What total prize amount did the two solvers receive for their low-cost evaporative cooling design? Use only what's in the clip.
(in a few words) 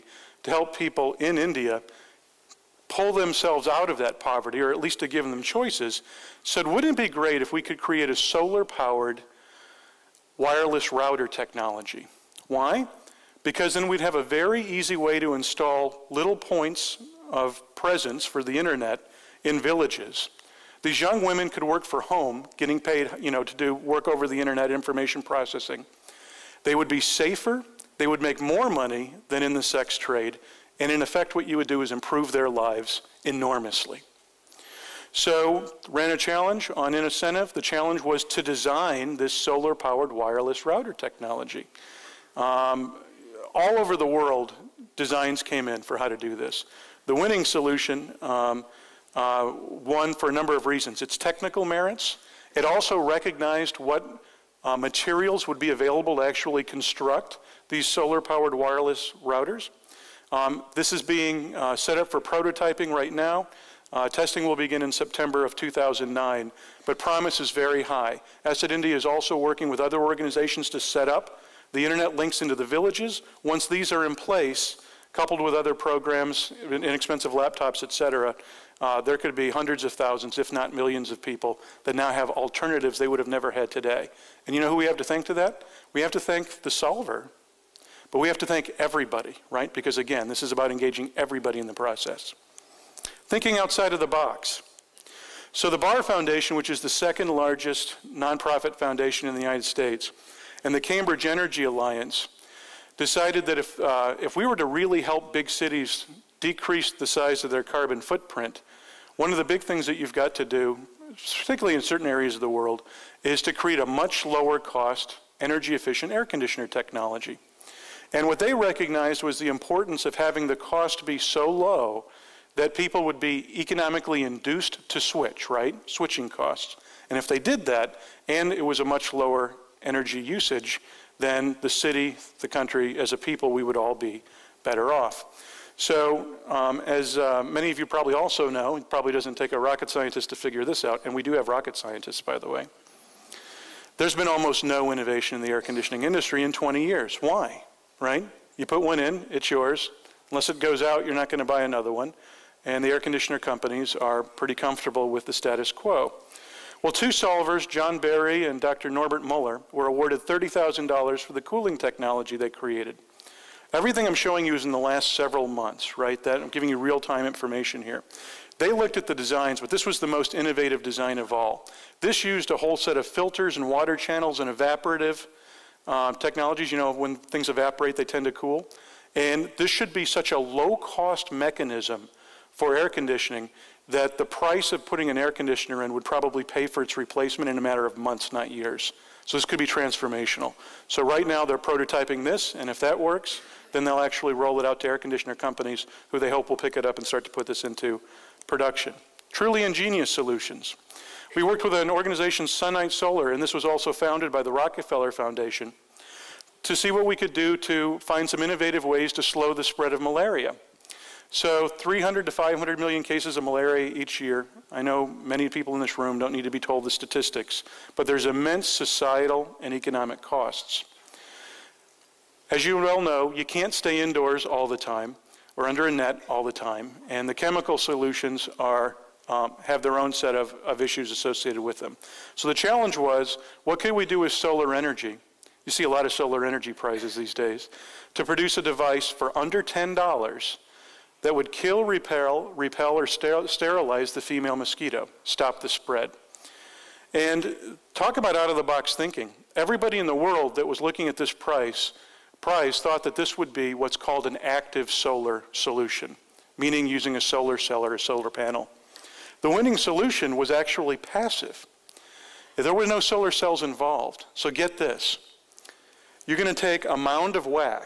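$30,000.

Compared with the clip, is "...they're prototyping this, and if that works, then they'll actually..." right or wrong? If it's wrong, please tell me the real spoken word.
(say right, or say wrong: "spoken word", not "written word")
right.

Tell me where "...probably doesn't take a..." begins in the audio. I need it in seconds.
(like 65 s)
138 s.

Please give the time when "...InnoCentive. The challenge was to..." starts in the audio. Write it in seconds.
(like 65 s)
36 s.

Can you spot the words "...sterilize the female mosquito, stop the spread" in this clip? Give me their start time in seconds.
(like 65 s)
243 s.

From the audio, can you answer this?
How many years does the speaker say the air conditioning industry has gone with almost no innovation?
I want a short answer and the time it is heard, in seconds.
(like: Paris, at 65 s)
20 years, at 146 s.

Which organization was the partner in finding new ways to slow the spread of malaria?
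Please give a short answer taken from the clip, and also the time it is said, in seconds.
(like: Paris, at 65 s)
SunNight Solar, at 202 s.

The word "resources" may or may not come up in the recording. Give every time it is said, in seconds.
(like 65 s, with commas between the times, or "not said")
not said.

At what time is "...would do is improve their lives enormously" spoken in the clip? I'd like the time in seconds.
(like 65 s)
31 s.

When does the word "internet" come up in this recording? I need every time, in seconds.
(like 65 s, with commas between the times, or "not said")
18 s, 24 s, 71 s.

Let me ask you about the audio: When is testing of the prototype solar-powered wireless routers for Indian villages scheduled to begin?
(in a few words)
September 2009.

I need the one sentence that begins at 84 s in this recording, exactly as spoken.
And you know who we have to thank to that?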